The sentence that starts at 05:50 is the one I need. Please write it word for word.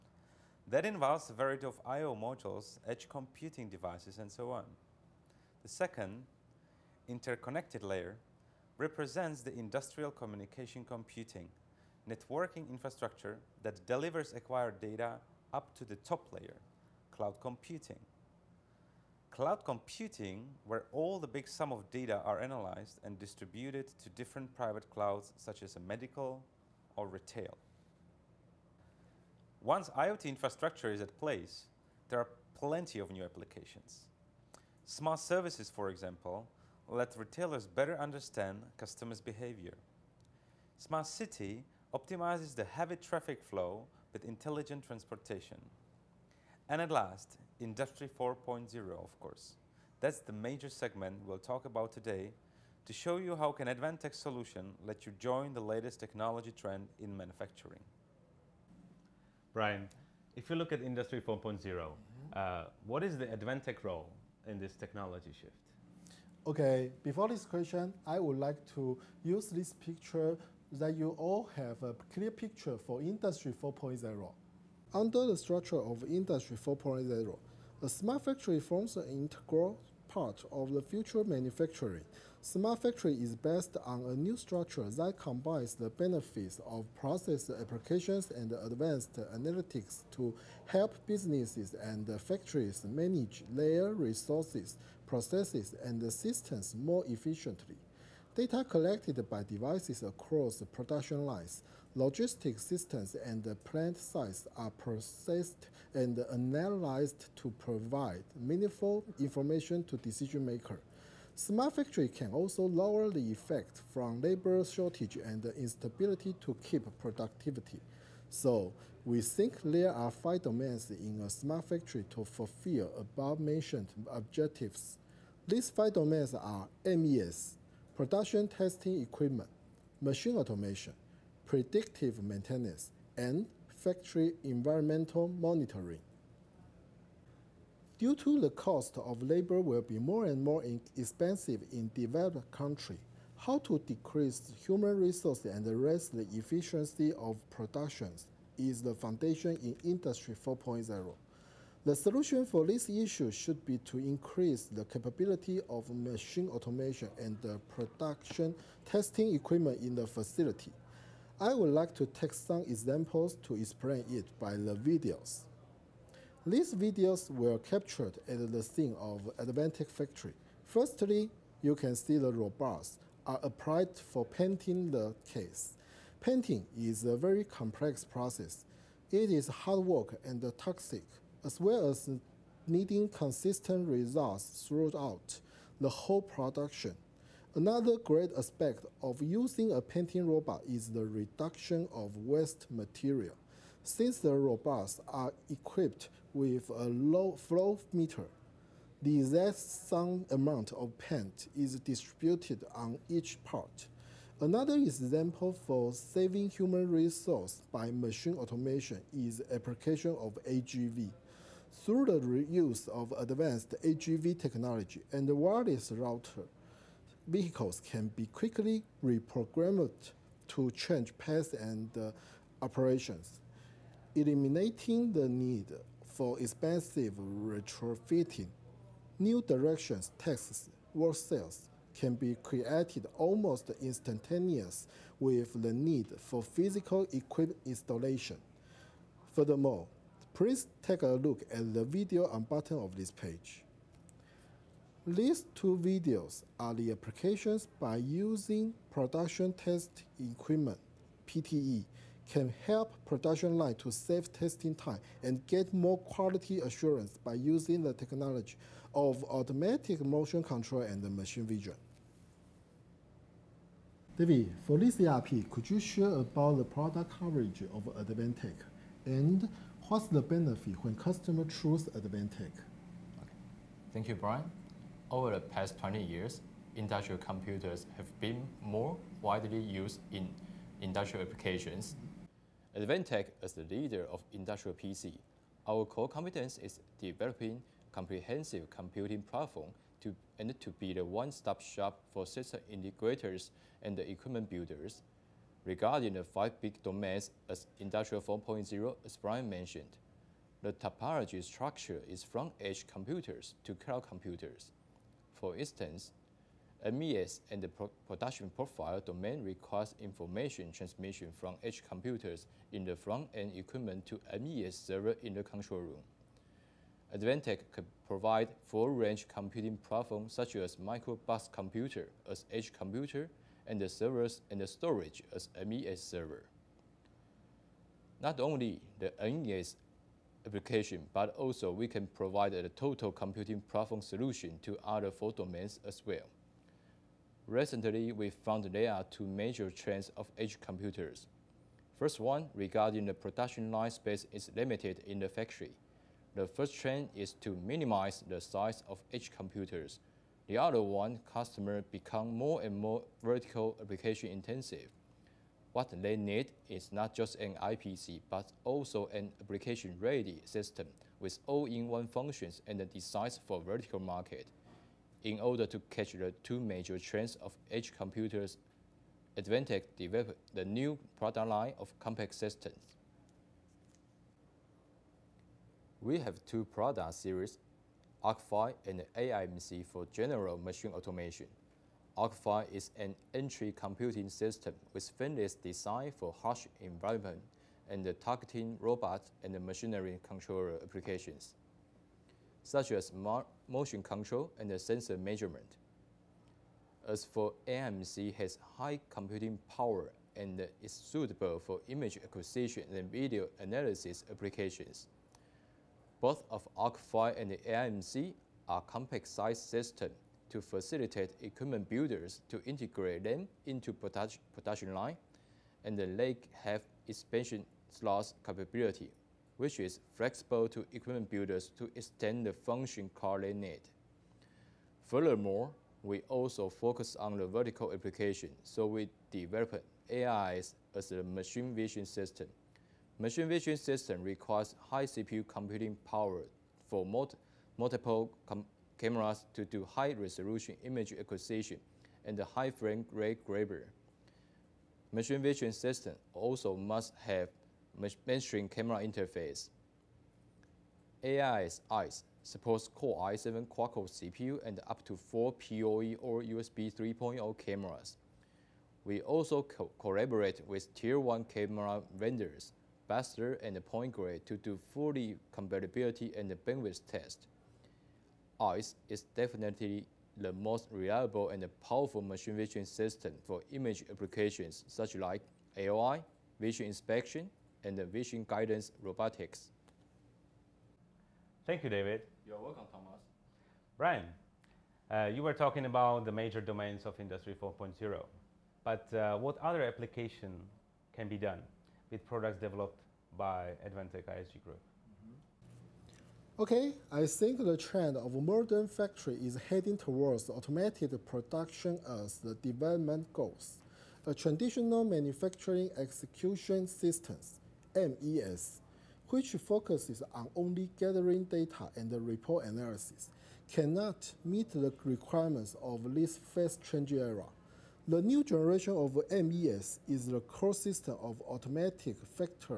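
The other one, customer become more and more vertical application intensive.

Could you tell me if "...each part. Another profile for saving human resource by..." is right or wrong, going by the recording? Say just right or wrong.
wrong.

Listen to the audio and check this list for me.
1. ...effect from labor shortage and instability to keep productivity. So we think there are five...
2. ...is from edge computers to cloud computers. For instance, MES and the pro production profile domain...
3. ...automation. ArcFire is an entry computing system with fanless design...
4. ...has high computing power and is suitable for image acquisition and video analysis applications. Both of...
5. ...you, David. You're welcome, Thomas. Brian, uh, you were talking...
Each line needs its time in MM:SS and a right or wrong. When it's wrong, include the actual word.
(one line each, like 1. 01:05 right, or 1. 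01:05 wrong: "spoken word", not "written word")
1. 01:53 right
2. 05:02 right
3. 06:20 right
4. 06:38 right
5. 08:01 right.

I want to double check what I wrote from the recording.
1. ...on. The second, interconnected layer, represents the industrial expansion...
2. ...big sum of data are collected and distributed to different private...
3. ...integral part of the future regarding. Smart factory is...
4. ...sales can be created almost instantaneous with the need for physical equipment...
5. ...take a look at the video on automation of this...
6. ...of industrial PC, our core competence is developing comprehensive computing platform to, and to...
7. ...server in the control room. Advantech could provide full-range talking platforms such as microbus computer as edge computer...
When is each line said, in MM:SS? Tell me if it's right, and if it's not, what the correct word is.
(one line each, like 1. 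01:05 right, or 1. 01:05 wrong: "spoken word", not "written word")
1. 00:04 wrong: "communication", not "expansion"
2. 00:21 wrong: "analyzed", not "collected"
3. 01:19 wrong: "manufacturing", not "regarding"
4. 03:51 right
5. 04:00 wrong: "button", not "automation"
6. 04:44 right
7. 05:14 wrong: "computing", not "talking".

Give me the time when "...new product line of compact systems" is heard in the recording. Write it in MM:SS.
06:10.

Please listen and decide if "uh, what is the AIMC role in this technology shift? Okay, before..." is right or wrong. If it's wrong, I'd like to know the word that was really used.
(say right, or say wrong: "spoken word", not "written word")
wrong: "Advantech", not "AIMC".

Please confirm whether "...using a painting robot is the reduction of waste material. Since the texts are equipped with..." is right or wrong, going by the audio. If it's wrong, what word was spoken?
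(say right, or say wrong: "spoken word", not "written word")
wrong: "robots", not "texts".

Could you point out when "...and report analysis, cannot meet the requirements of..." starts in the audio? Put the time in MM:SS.
08:31.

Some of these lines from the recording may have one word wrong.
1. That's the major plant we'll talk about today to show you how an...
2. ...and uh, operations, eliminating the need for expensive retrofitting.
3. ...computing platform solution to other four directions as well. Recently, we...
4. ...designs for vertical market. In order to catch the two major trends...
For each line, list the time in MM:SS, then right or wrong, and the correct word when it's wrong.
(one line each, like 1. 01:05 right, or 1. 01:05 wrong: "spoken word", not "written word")
1. 00:49 wrong: "segment", not "plant"
2. 03:41 right
3. 05:33 wrong: "domains", not "directions"
4. 06:02 right.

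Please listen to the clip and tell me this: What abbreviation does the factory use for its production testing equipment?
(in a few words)
PTE.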